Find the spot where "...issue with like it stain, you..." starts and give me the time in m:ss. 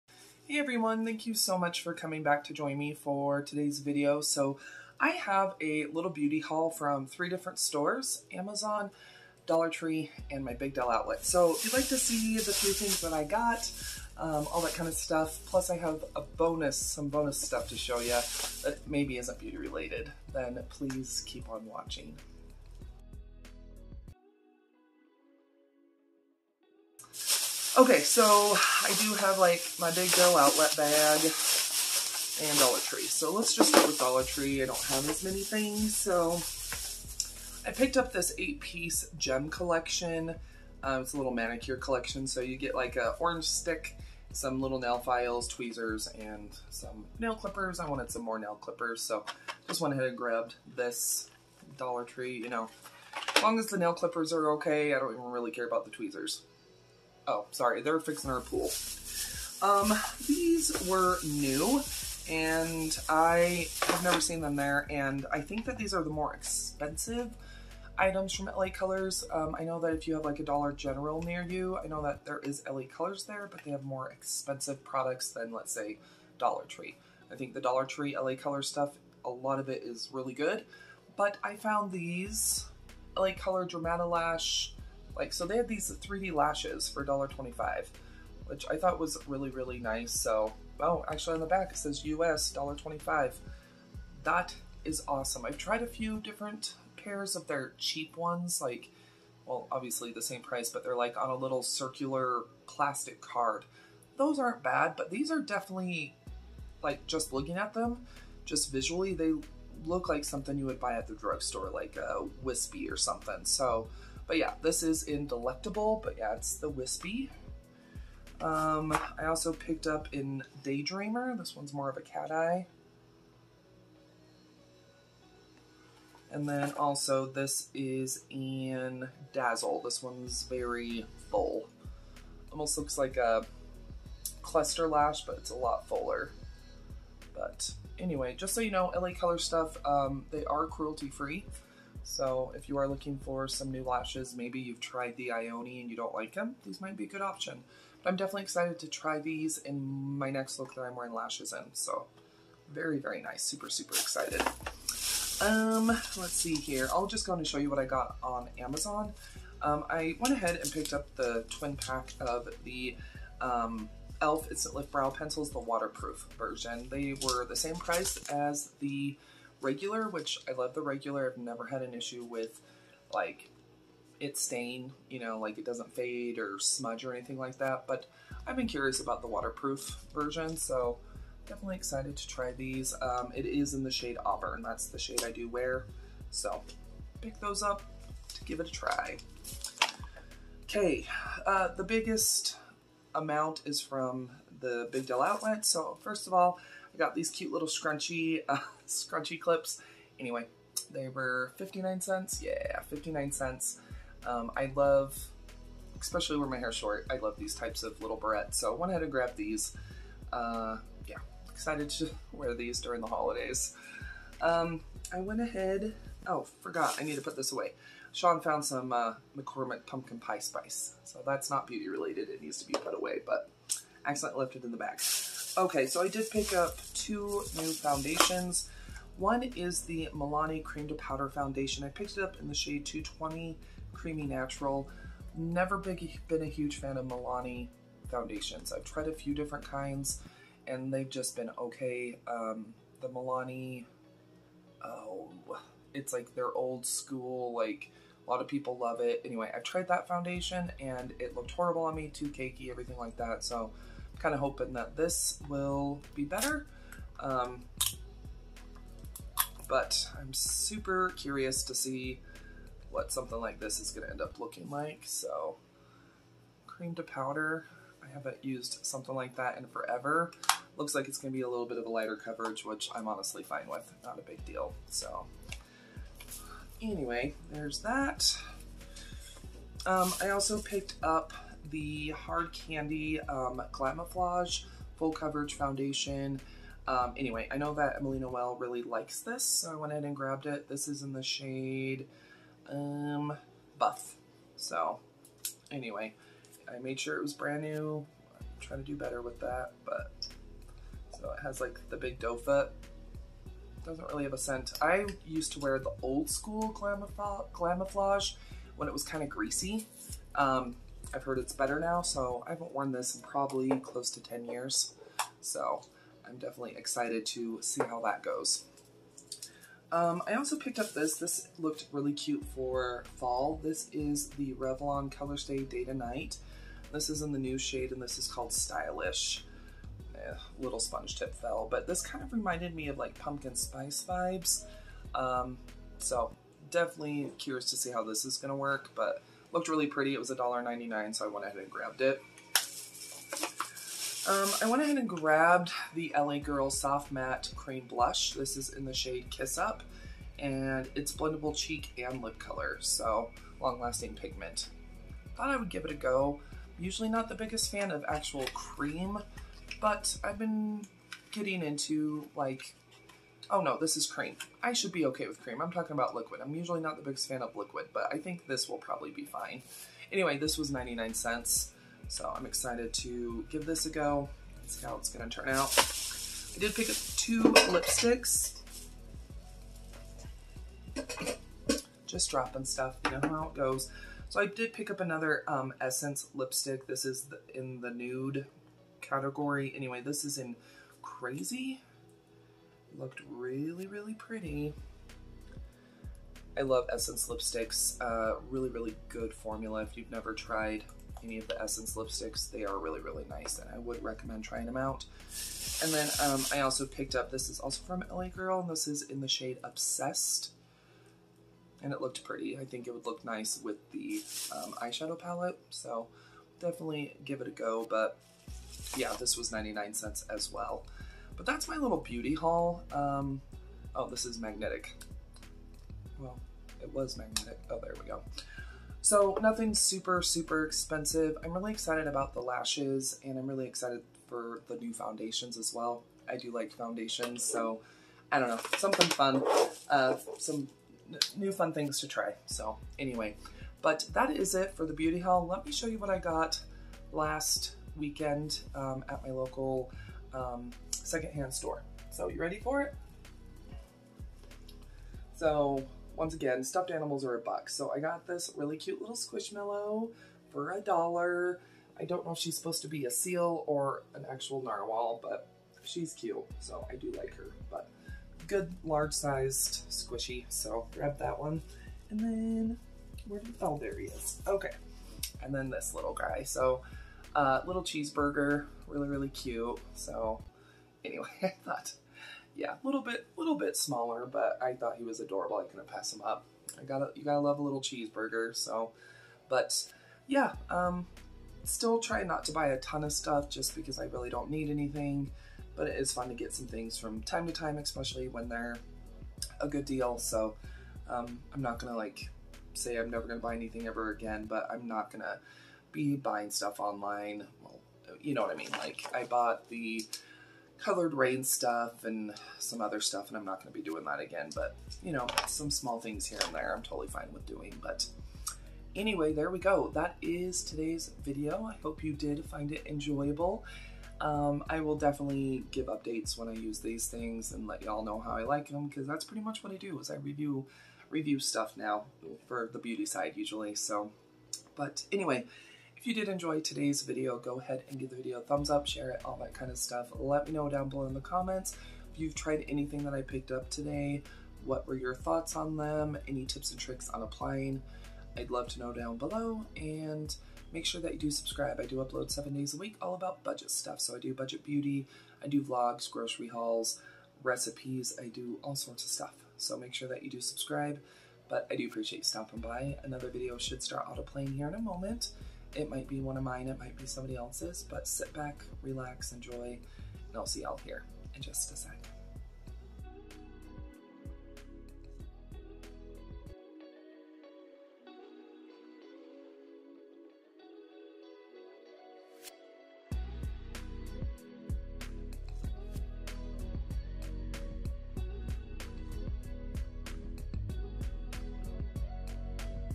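2:51.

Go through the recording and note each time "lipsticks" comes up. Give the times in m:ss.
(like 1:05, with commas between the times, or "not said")
6:17, 6:26, 6:37, 6:41.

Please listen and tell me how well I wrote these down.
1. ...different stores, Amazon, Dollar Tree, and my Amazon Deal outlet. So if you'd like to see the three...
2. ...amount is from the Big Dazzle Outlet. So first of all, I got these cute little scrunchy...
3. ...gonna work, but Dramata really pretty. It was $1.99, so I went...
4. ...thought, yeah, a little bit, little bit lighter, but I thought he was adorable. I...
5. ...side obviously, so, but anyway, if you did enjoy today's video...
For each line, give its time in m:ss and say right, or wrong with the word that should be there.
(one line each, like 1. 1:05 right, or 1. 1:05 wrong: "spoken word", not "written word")
1. 0:07 wrong: "Big", not "Amazon"
2. 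3:13 wrong: "Deal", not "Dazzle"
3. 5:38 wrong: "Looked", not "Dramata"
4. 8:01 wrong: "smaller", not "lighter"
5. 8:53 wrong: "usually", not "obviously".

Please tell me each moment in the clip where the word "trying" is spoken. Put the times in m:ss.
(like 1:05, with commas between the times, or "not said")
4:58, 6:44.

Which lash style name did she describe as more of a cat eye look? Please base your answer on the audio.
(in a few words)
Daydreamer.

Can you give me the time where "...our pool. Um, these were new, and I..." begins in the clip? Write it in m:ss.
0:58.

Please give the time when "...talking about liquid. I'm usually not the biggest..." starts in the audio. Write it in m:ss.
6:05.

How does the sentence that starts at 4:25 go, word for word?
So cream to powder, I haven't used something like that in forever.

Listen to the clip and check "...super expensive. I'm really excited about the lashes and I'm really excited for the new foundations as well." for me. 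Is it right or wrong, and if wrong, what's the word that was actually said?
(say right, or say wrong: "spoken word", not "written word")
right.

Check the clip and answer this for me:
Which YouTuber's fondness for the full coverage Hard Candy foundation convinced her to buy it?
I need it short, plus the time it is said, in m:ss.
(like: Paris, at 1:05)
Emily Noel, at 4:47.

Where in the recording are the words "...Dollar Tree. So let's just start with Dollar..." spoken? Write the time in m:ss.
0:32.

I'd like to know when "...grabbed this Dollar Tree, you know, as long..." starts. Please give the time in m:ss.
0:50.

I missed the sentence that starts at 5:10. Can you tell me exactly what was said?
Um, I've heard it's better now, so I haven't worn this in probably close to 10 years.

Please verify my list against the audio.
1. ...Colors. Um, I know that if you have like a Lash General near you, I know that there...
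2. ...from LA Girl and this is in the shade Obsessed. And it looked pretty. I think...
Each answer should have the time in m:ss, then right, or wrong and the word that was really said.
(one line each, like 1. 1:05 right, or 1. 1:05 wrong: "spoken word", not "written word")
1. 1:08 wrong: "Dollar", not "Lash"
2. 6:47 right.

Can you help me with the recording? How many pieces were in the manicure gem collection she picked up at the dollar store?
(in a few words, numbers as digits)
8.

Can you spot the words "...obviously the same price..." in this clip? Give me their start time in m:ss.
1:39.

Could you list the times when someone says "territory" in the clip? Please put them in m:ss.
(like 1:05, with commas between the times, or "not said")
not said.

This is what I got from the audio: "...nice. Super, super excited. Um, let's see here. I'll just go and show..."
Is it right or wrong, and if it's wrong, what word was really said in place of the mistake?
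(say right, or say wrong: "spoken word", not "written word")
right.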